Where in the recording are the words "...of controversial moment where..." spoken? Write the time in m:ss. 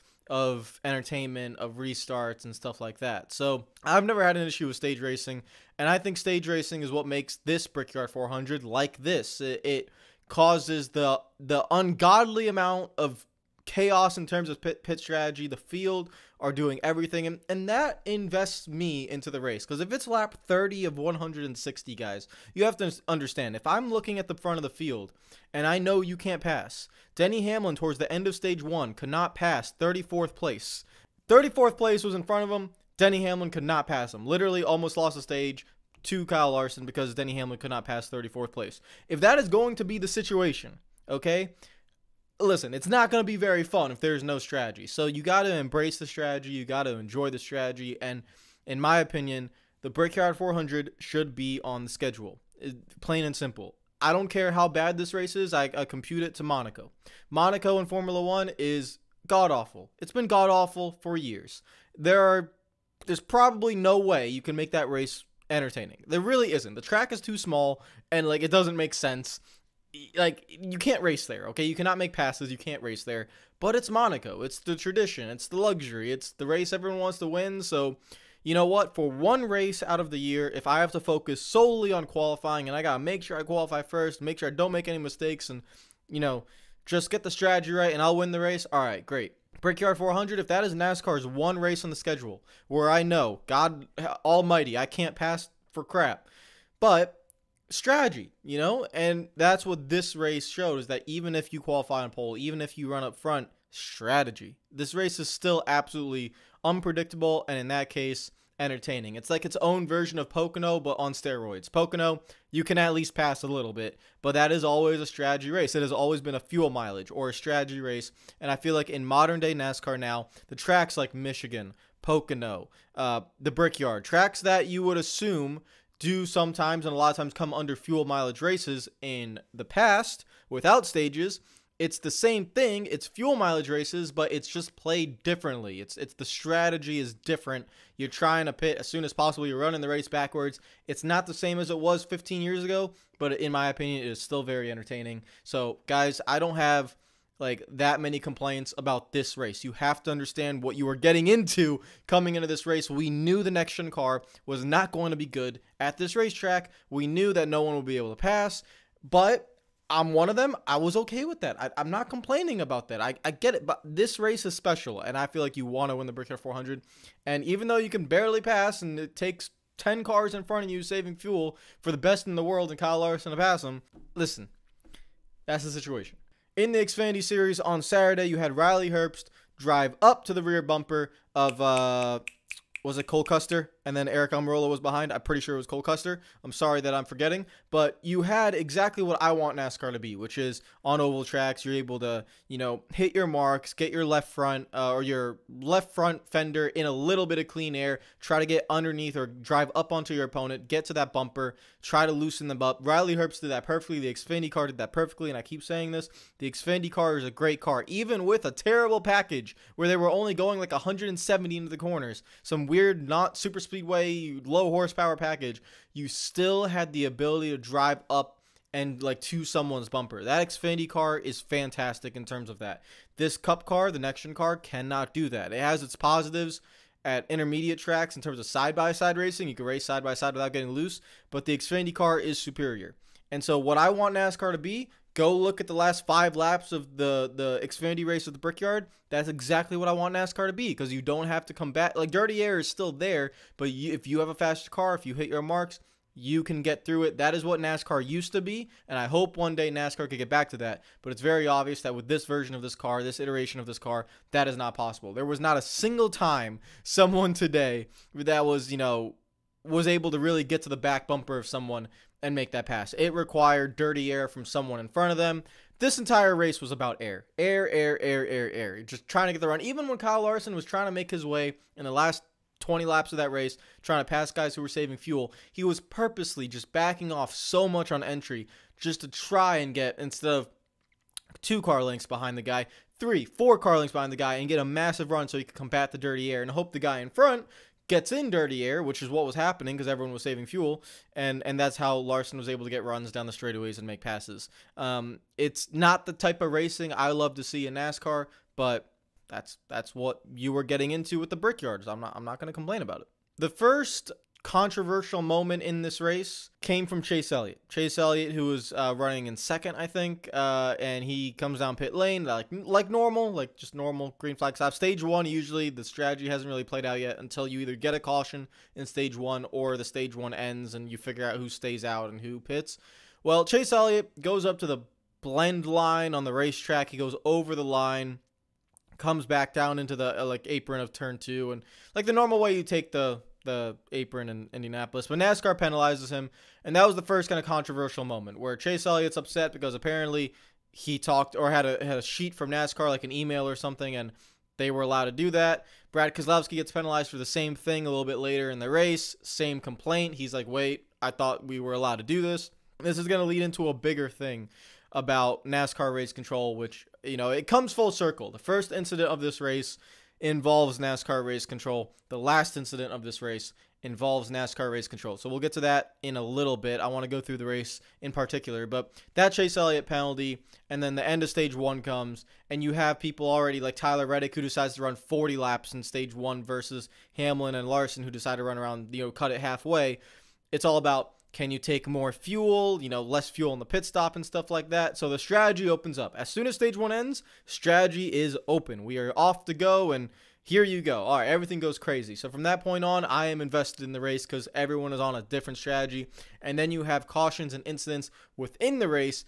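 5:37.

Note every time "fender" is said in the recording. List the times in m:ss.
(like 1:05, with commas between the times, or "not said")
3:16.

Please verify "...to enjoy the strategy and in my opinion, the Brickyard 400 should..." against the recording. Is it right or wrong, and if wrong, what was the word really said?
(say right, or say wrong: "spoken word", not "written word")
right.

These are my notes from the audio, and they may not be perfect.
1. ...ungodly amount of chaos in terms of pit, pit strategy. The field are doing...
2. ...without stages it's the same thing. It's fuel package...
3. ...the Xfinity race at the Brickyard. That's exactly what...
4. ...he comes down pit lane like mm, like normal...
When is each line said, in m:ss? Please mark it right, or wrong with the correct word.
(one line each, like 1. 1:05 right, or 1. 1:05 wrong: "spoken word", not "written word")
1. 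0:11 right
2. 2:10 wrong: "mileage", not "package"
3. 3:57 right
4. 5:11 right.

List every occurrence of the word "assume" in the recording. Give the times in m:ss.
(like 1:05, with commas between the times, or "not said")
2:04.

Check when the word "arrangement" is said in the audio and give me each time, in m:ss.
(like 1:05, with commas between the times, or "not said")
not said.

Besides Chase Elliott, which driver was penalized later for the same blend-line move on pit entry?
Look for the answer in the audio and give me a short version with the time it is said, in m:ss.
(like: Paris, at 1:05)
Brad Keselowski, at 5:45.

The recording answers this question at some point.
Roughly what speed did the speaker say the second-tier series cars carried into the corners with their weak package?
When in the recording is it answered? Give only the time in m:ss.
3:30.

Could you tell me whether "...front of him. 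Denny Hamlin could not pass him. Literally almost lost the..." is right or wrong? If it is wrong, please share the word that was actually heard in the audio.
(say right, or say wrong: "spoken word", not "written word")
right.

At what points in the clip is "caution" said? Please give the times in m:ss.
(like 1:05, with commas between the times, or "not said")
5:17, 6:37.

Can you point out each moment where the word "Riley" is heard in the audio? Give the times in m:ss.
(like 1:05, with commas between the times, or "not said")
2:58, 3:22.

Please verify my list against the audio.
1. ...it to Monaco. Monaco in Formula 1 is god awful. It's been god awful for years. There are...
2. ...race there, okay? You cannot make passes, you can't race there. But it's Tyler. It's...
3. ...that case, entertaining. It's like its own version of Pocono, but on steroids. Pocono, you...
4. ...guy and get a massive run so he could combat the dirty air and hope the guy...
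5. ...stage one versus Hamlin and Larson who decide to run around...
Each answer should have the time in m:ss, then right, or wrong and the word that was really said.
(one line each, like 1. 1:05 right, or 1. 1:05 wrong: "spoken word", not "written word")
1. 0:56 right
2. 1:11 wrong: "Monaco", not "Tyler"
3. 1:47 right
4. 4:44 right
5. 6:15 right.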